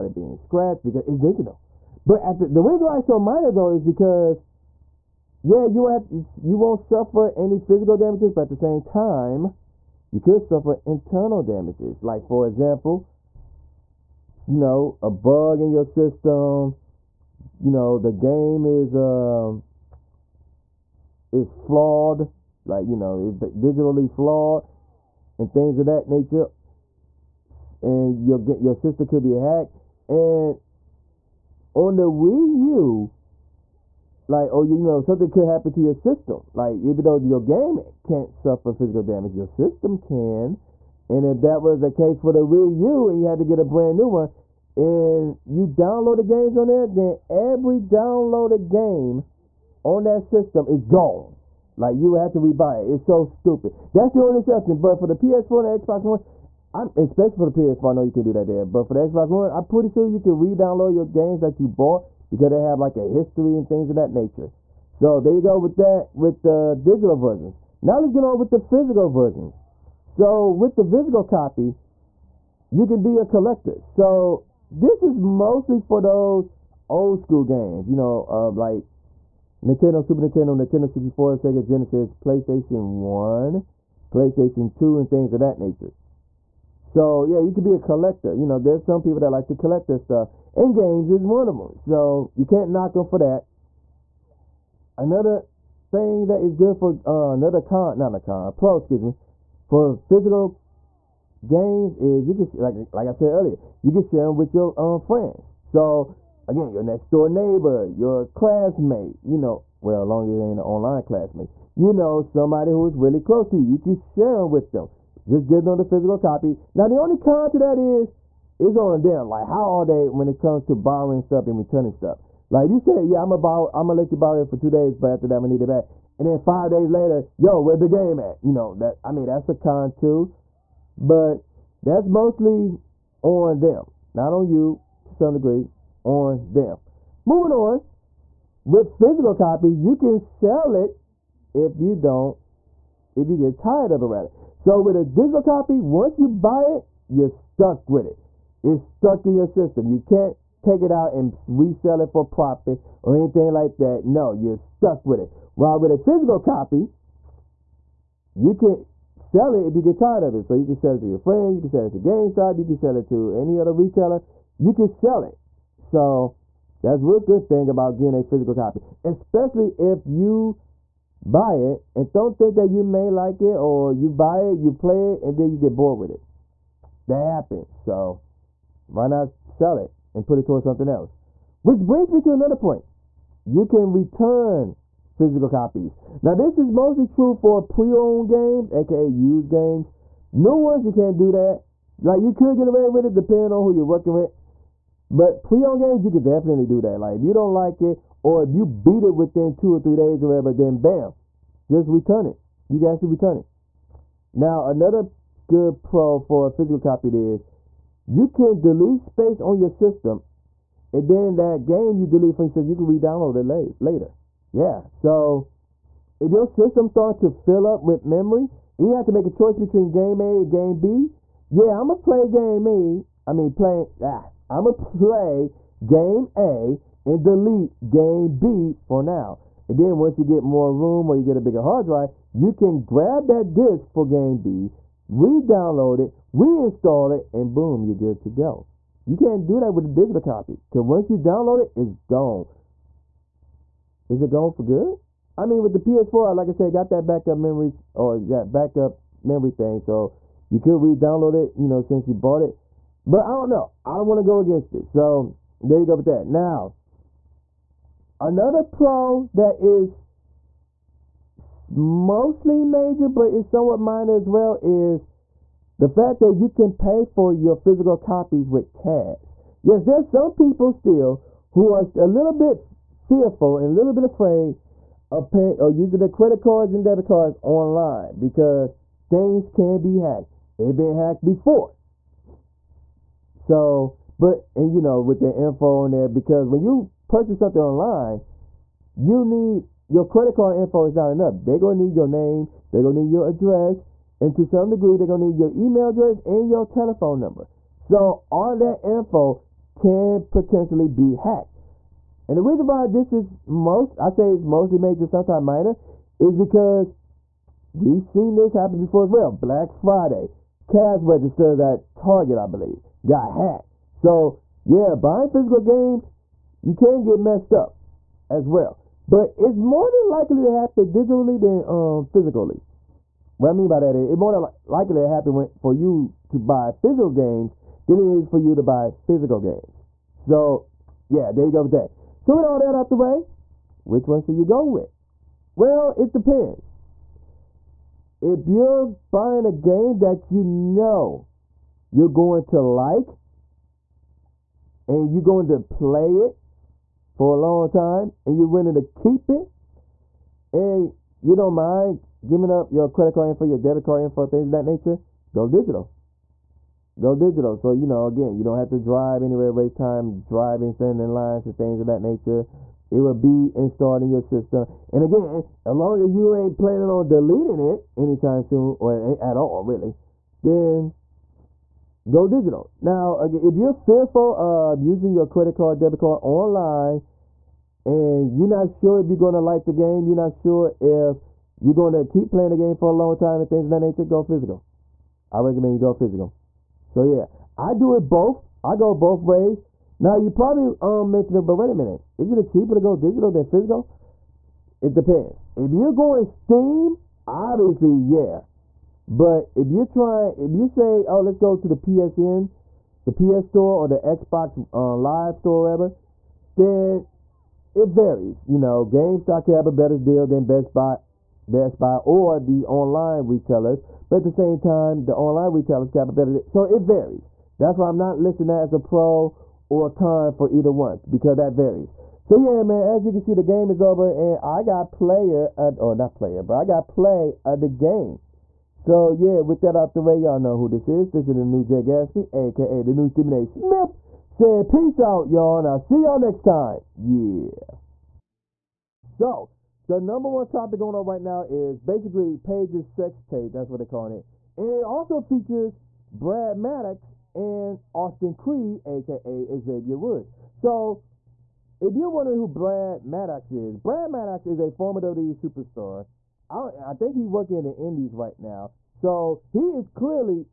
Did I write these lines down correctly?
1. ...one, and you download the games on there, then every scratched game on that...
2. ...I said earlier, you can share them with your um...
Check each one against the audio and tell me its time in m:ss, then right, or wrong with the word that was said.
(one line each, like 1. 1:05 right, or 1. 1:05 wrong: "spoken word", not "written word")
1. 0:44 wrong: "downloaded", not "scratched"
2. 1:43 right.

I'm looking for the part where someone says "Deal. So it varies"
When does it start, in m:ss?
6:56.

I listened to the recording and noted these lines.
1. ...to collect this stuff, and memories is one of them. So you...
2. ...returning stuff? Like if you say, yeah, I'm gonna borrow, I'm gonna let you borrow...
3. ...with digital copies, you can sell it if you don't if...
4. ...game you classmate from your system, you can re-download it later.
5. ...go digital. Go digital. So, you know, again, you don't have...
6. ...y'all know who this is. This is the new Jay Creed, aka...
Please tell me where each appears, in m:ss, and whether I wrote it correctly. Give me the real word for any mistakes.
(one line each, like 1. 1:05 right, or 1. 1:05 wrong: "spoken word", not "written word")
1. 1:29 wrong: "games", not "memories"
2. 2:01 right
3. 2:18 wrong: "physical", not "digital"
4. 3:31 wrong: "delete", not "classmate"
5. 5:55 right
6. 7:10 wrong: "Gatsby", not "Creed".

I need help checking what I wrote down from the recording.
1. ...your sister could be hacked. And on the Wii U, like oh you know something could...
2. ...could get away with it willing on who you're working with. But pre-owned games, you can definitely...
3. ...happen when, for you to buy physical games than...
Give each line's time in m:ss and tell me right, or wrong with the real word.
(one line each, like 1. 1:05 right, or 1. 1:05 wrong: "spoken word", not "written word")
1. 0:28 right
2. 3:12 wrong: "depending", not "willing"
3. 5:25 right.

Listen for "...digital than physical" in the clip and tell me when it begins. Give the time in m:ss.
6:32.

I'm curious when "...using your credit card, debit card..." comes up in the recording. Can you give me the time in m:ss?
6:14.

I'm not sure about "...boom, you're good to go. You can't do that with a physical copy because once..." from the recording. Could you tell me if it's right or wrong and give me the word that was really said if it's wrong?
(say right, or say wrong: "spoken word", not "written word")
wrong: "digital", not "physical".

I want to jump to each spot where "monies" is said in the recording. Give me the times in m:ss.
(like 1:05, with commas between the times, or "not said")
not said.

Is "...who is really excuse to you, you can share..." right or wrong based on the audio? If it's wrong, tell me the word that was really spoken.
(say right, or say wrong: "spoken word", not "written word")
wrong: "close", not "excuse".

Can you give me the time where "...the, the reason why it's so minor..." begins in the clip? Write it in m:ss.
0:02.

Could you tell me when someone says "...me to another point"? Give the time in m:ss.
3:02.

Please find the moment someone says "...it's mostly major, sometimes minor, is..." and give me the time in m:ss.
5:04.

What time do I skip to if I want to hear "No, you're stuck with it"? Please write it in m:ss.
2:34.